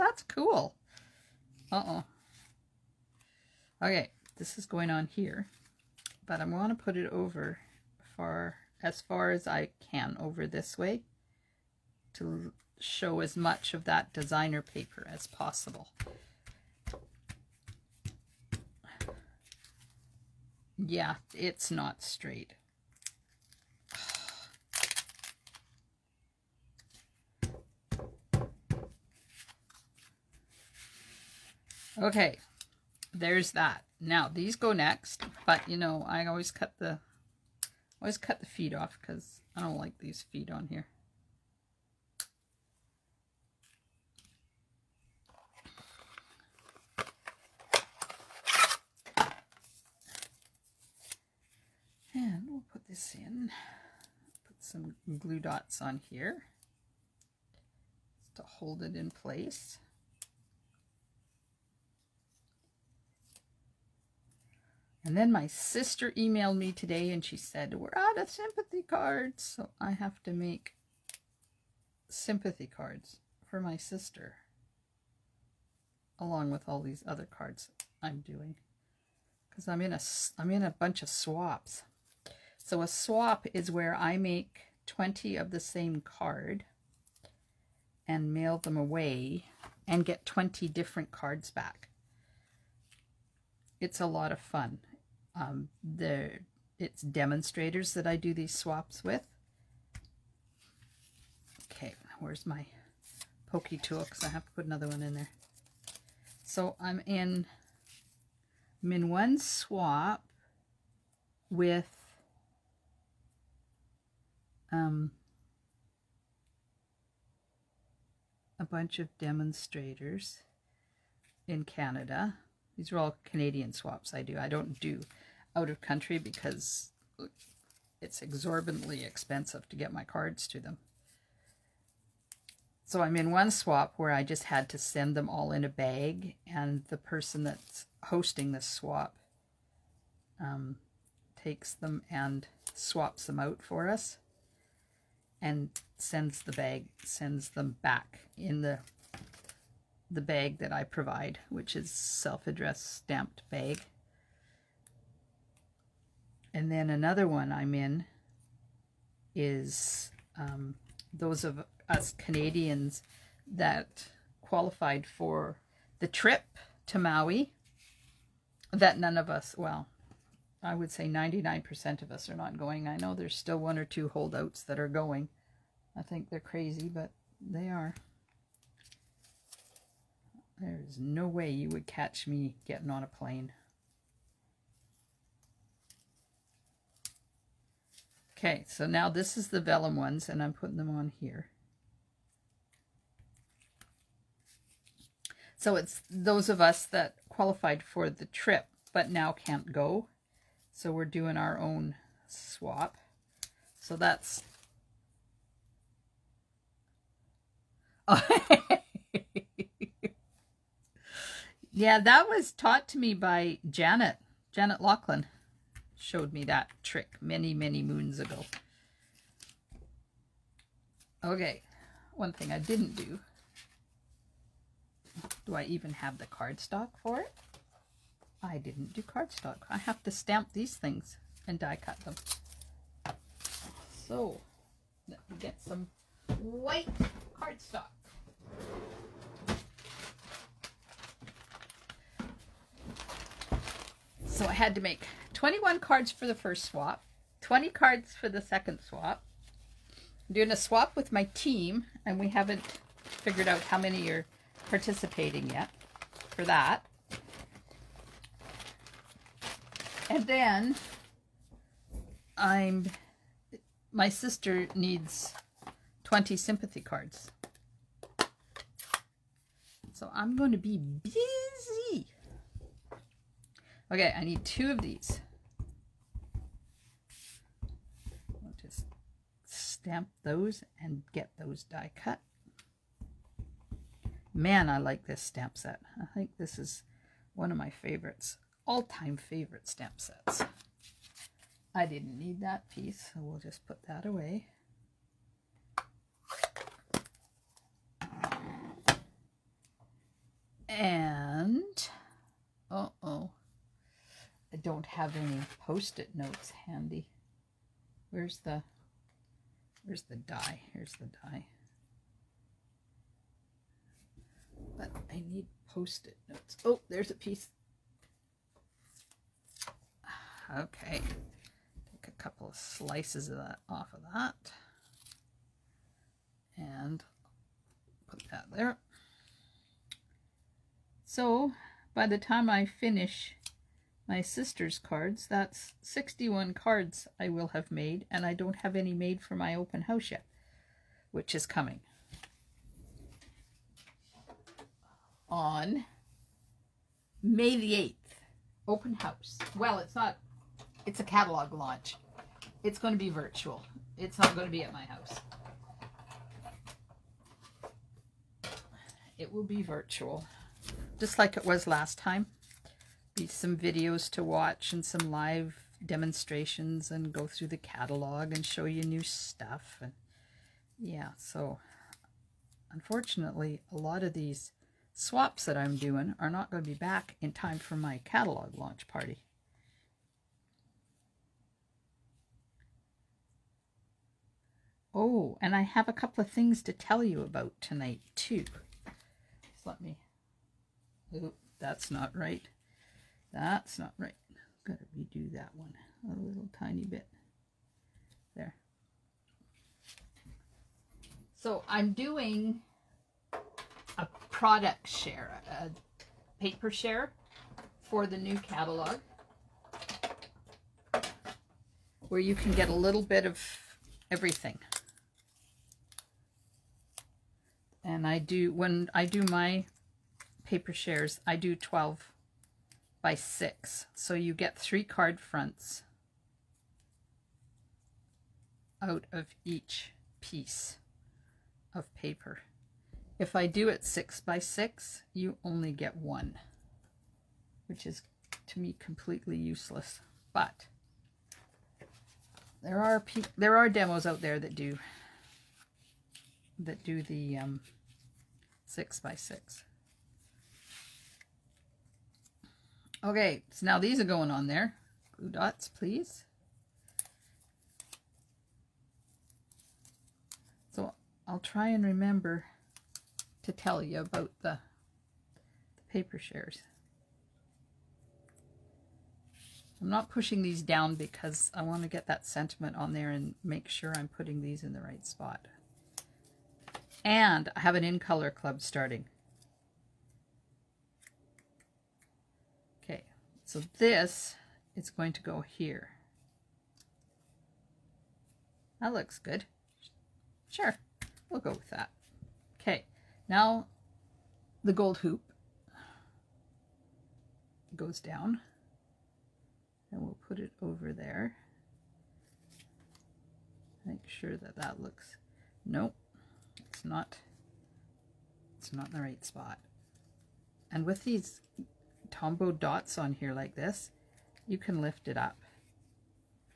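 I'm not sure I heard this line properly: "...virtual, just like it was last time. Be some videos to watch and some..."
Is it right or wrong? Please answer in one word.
right.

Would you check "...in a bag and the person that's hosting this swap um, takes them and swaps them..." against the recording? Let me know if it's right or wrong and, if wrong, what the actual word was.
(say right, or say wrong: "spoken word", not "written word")
right.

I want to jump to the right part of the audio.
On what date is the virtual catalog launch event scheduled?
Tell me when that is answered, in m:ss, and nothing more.
5:47.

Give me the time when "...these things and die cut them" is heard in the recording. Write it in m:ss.
3:50.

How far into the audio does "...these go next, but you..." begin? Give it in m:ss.
0:34.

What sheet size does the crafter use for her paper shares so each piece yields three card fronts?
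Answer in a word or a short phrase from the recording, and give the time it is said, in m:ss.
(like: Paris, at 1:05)
12 by 6, at 7:01.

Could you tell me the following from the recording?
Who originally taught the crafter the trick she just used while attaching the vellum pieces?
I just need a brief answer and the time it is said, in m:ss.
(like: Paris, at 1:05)
Janet Lachlan, at 3:34.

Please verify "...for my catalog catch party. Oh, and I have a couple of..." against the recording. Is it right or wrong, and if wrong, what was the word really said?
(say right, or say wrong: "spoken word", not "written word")
wrong: "launch", not "catch".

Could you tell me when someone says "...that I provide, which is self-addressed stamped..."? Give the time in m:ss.
2:30.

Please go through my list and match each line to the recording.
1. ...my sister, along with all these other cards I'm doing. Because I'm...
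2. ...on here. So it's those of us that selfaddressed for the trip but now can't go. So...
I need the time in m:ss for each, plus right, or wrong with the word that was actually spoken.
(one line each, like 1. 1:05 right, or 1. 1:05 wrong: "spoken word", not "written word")
1. 1:13 right
2. 3:10 wrong: "qualified", not "selfaddressed".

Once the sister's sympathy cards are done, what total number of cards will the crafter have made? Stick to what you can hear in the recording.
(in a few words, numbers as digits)
61.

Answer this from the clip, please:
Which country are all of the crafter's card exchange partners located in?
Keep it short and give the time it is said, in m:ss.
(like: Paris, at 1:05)
Canada, at 2:01.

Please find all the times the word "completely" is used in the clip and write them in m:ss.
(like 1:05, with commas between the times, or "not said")
7:18.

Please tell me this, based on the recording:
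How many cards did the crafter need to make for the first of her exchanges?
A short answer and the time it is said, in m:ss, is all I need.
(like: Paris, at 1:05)
21, at 4:05.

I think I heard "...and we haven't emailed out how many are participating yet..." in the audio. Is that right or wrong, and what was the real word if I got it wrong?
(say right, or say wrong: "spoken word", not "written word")
wrong: "figured", not "emailed".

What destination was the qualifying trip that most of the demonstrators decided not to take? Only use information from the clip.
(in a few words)
Maui.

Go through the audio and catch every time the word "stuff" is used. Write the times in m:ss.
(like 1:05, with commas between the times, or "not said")
6:09.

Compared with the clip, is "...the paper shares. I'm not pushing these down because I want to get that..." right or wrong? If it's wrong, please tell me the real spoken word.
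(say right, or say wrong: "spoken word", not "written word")
right.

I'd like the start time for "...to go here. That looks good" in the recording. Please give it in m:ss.
8:05.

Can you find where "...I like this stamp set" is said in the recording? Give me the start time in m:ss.
4:44.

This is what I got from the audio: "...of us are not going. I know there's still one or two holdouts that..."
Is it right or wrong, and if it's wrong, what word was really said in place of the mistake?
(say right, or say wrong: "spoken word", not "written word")
right.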